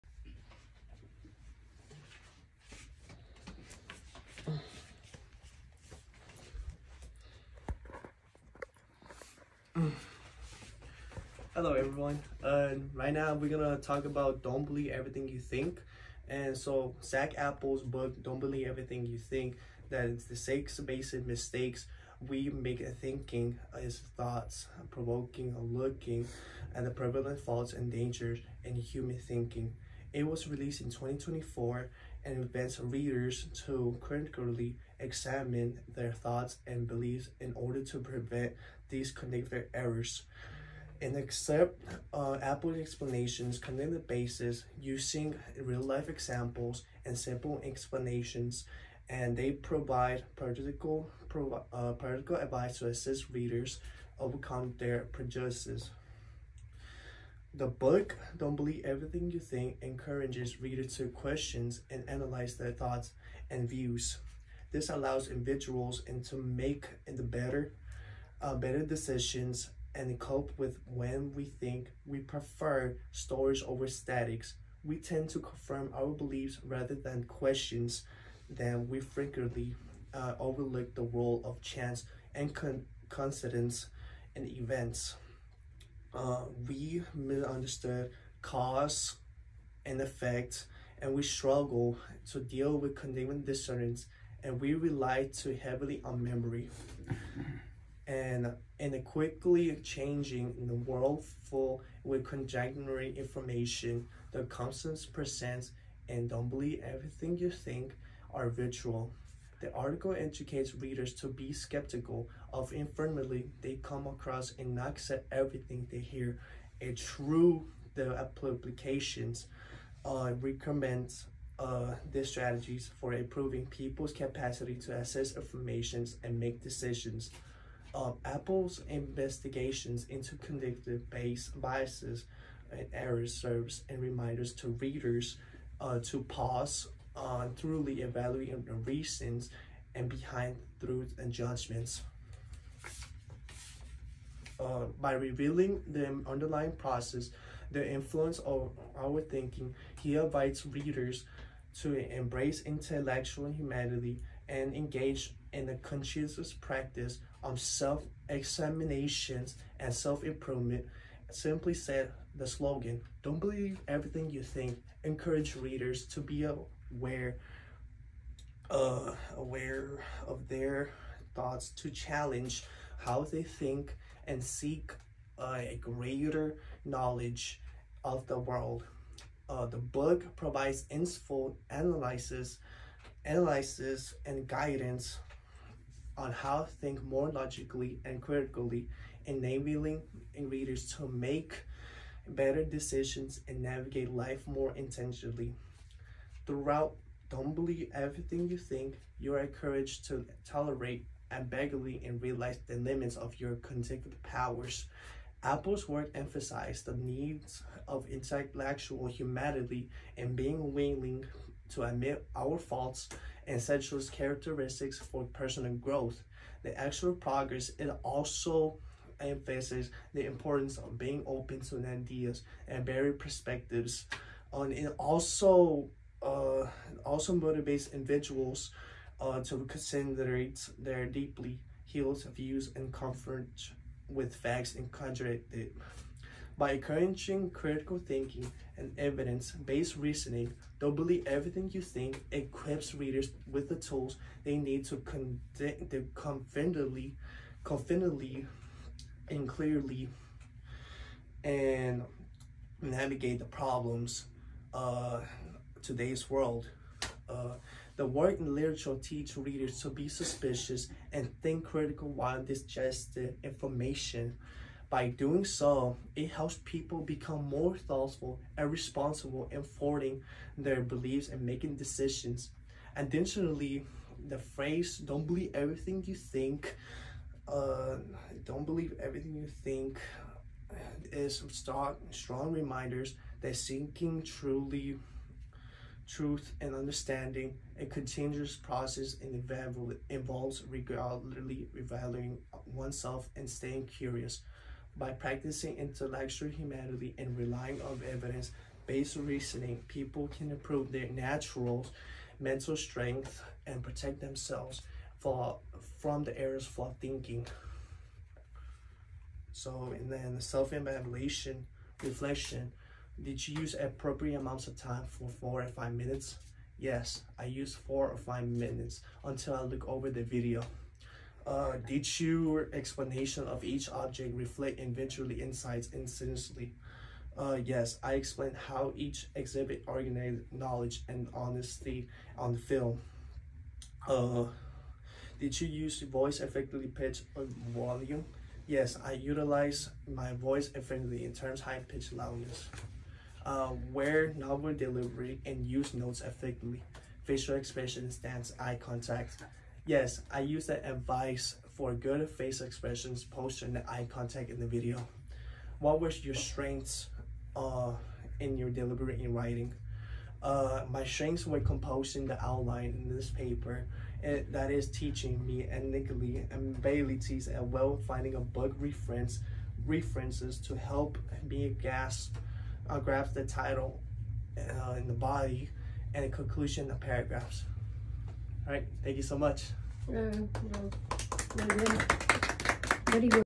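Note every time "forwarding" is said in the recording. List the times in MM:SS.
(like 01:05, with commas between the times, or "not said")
04:29.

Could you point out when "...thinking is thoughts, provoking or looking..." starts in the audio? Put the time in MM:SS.
00:22.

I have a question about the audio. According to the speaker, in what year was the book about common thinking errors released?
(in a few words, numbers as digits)
2024.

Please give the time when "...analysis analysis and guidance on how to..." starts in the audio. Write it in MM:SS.
03:01.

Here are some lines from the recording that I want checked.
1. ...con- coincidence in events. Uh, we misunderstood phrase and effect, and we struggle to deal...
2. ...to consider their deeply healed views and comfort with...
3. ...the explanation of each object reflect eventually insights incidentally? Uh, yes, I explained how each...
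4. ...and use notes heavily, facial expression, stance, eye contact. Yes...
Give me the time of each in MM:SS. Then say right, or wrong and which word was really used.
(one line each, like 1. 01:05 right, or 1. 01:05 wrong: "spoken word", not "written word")
1. 01:22 wrong: "cause", not "phrase"
2. 03:49 right
3. 05:21 right
4. 05:45 wrong: "effectively", not "heavily".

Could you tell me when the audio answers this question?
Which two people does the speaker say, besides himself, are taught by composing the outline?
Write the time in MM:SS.
06:05.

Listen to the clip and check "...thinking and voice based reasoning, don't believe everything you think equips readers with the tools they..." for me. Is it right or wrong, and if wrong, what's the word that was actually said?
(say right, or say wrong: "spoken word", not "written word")
wrong: "evidence", not "voice".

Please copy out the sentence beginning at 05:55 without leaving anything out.
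What were your strengths uh, in your delivery in writing?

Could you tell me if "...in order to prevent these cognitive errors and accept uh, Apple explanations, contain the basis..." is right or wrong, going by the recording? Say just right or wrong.
right.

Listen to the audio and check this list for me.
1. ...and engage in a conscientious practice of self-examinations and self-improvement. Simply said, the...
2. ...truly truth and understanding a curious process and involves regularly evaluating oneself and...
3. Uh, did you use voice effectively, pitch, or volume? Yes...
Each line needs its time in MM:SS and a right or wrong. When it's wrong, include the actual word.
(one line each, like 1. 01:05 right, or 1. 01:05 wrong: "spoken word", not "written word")
1. 02:34 right
2. 04:44 wrong: "continuous", not "curious"
3. 05:34 right.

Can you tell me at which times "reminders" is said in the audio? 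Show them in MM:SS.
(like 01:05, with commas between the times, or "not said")
02:14, 04:42.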